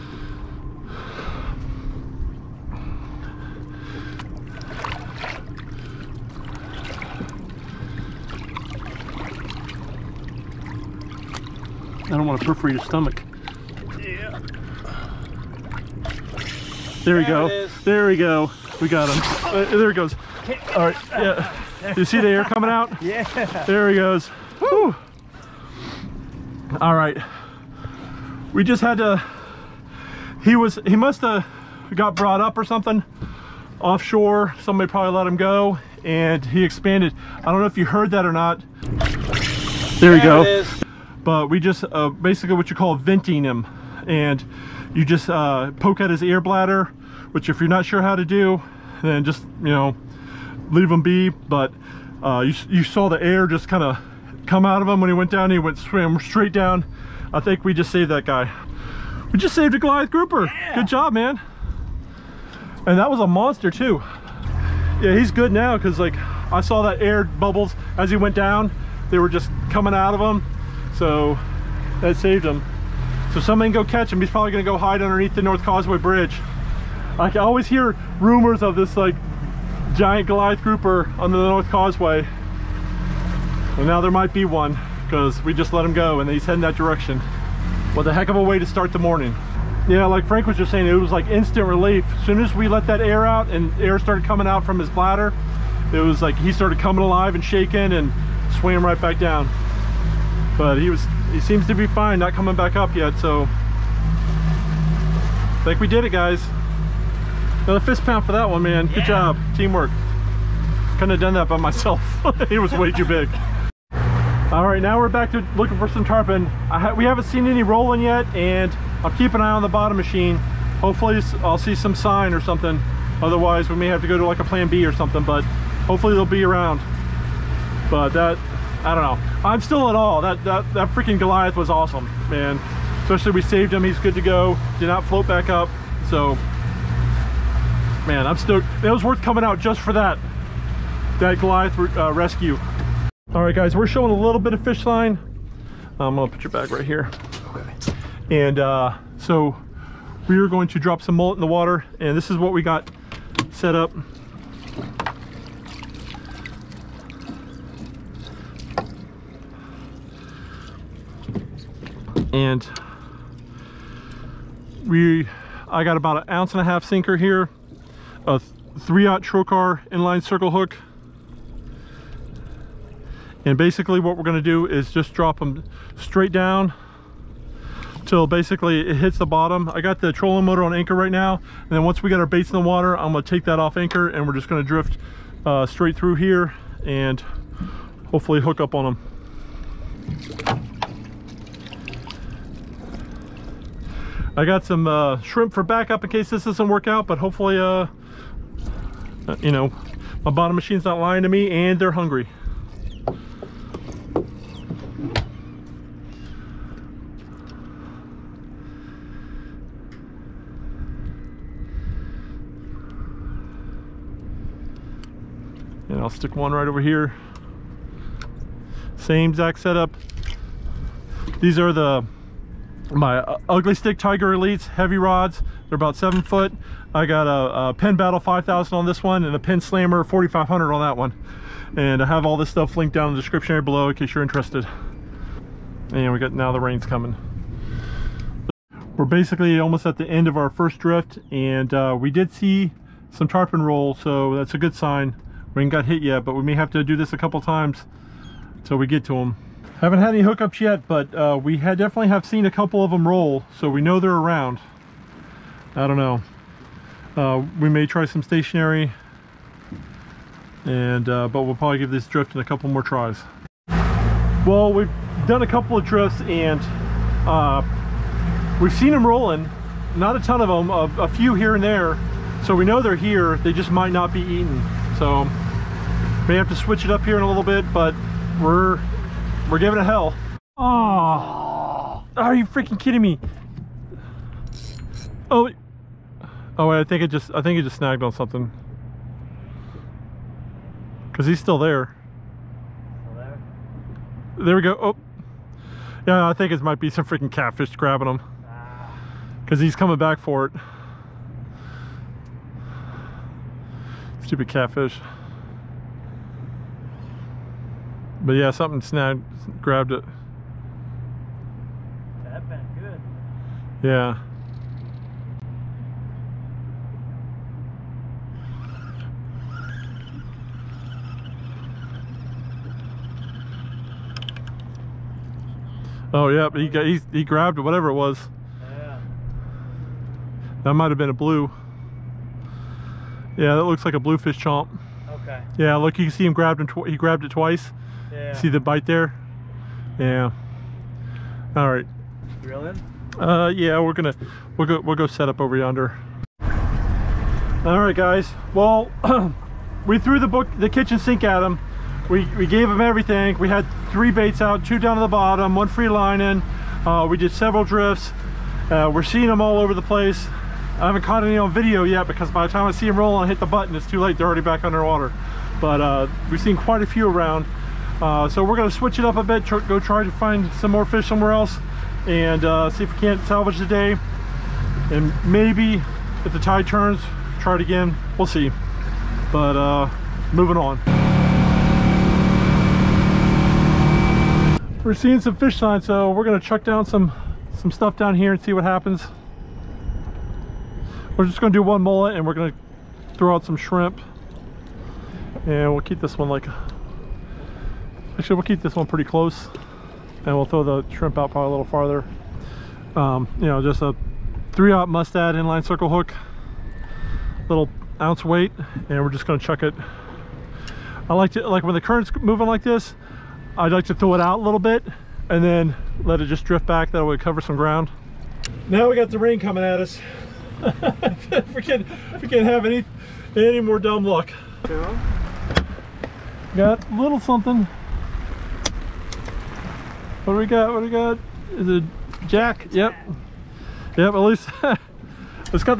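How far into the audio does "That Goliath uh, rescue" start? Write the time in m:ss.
2:21.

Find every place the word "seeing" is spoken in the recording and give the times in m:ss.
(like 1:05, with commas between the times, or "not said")
5:59, 6:24.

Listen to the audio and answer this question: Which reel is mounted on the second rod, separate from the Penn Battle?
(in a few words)
Penn Slammer 4500.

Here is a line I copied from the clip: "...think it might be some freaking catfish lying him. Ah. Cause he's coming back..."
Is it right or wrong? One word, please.
wrong.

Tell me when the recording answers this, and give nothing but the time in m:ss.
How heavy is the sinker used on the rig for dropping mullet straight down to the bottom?
2:46.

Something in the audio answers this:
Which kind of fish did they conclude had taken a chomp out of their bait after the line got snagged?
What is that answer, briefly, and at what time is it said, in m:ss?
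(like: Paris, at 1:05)
bluefish, at 5:33.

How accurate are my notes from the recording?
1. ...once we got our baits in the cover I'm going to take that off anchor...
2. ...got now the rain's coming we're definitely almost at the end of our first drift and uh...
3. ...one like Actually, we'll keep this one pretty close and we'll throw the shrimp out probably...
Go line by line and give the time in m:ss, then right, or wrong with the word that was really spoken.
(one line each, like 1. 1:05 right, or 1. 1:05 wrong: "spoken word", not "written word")
1. 3:01 wrong: "water", not "cover"
2. 3:56 wrong: "basically", not "definitely"
3. 6:36 right.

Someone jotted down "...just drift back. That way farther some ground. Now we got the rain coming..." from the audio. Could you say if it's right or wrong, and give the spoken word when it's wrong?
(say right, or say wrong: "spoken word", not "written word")
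wrong: "cover", not "farther".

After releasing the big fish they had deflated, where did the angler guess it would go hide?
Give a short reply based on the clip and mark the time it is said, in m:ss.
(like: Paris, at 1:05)
North Causeway Bridge, at 1:15.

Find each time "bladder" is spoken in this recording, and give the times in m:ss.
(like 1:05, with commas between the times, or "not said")
0:46, 1:34.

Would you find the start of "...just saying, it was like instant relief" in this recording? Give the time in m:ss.
1:30.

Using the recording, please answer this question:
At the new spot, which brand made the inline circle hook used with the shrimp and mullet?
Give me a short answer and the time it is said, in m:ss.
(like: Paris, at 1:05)
Mustad, at 6:44.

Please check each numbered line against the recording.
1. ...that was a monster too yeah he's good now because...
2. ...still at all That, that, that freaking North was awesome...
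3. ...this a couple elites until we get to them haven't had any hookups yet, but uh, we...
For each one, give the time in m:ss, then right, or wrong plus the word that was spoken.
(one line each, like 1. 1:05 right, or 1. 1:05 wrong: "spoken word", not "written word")
1. 1:02 right
2. 2:09 wrong: "Goliath", not "North"
3. 4:06 wrong: "times", not "elites".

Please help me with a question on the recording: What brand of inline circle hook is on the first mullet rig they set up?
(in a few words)
Trokar.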